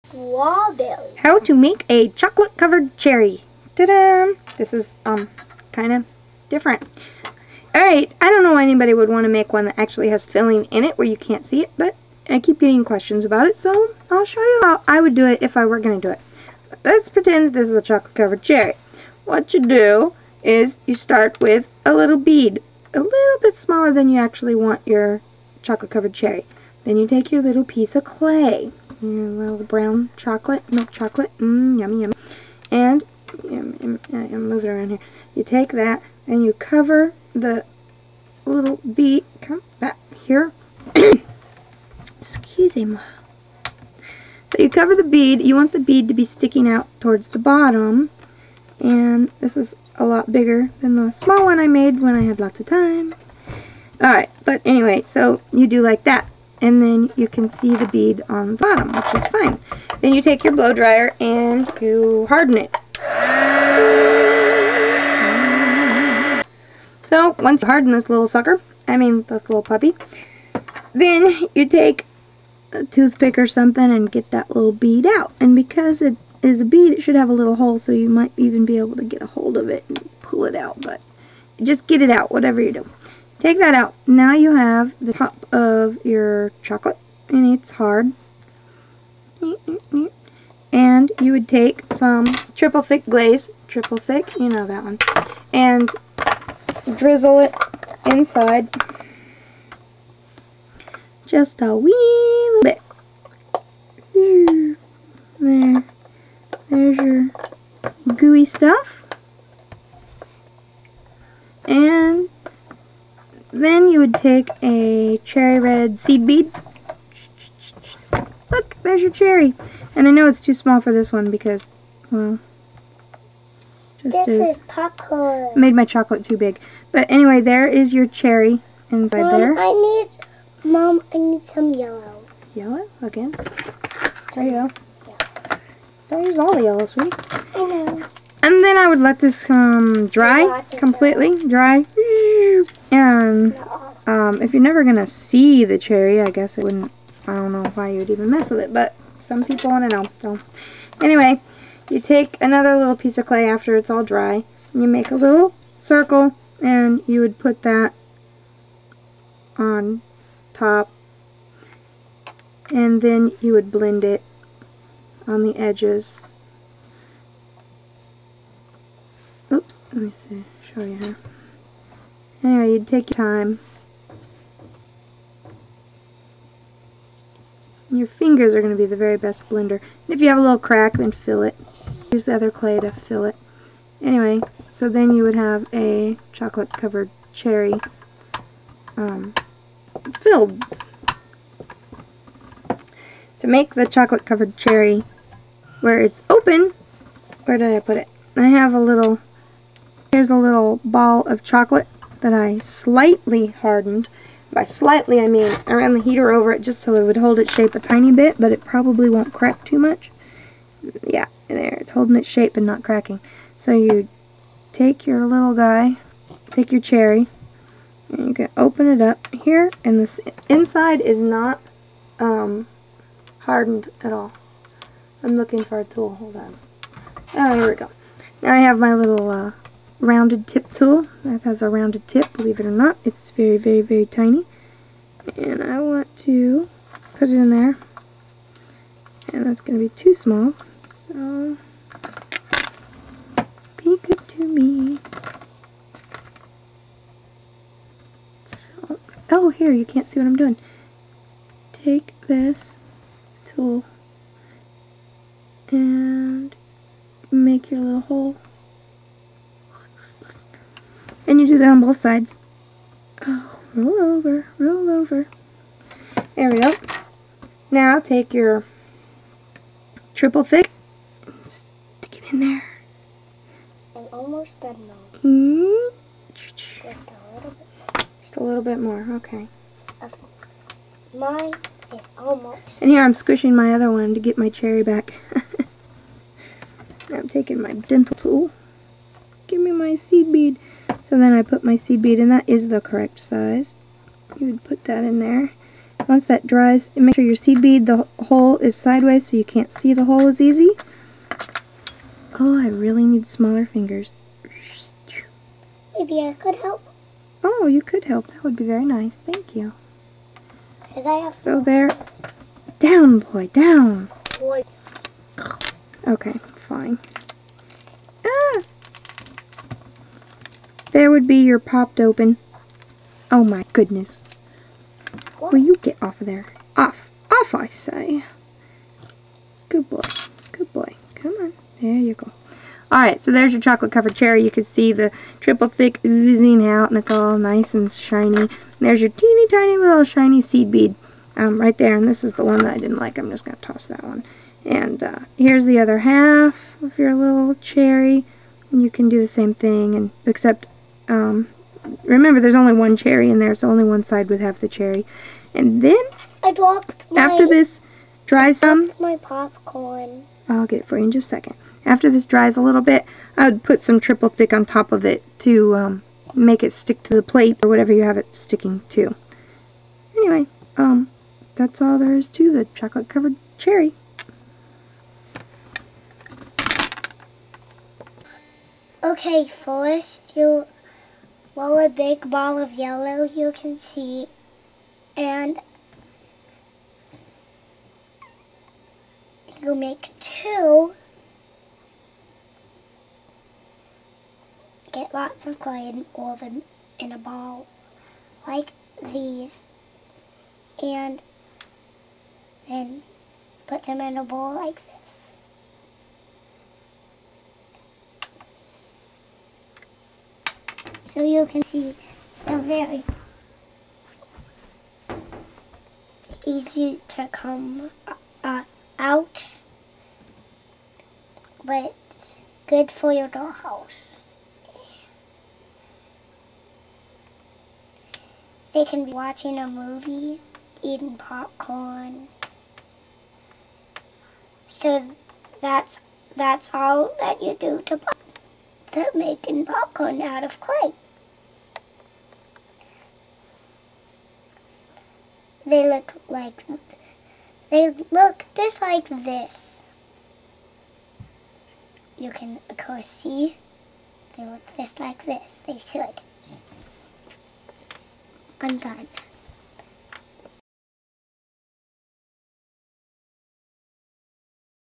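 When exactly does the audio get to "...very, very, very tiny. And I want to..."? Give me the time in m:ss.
3:53.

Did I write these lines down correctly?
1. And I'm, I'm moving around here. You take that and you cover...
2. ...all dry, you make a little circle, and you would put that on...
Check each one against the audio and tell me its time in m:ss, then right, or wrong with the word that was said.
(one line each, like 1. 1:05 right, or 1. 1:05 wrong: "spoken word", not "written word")
1. 0:32 right
2. 2:33 right.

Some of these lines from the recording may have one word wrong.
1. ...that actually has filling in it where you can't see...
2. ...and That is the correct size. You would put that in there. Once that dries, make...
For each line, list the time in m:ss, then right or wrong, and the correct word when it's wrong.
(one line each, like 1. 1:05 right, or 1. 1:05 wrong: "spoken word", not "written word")
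1. 0:09 right
2. 4:52 right.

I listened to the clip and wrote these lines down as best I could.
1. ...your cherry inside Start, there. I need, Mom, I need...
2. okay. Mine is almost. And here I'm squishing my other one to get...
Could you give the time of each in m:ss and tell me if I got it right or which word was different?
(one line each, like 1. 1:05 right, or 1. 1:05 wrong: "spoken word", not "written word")
1. 2:07 wrong: "Mom", not "Start"
2. 4:40 right.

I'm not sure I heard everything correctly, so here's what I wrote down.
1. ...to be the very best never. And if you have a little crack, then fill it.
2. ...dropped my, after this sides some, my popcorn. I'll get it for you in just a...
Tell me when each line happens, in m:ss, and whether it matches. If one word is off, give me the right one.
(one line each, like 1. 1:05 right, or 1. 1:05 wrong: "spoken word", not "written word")
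1. 2:58 wrong: "blender", not "never"
2. 5:56 wrong: "dries", not "sides".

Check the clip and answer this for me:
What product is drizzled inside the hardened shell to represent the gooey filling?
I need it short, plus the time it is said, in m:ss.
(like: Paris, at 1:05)
triple thick glaze, at 1:32.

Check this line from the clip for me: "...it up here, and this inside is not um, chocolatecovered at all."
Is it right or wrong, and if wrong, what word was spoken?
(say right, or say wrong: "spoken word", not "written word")
wrong: "hardened", not "chocolatecovered".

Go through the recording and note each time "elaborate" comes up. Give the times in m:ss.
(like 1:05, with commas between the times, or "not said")
not said.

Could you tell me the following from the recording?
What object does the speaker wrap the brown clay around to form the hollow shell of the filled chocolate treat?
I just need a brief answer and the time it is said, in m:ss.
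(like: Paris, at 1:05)
a bead, at 0:21.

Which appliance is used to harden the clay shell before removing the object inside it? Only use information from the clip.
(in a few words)
blow dryer.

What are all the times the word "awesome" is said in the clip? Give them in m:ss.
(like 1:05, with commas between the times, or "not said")
not said.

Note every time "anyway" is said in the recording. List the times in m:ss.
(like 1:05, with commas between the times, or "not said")
0:54, 2:07, 2:31, 2:52, 3:04, 6:10.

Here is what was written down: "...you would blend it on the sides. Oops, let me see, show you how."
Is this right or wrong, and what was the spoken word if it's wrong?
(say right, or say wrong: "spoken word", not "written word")
wrong: "edges", not "sides".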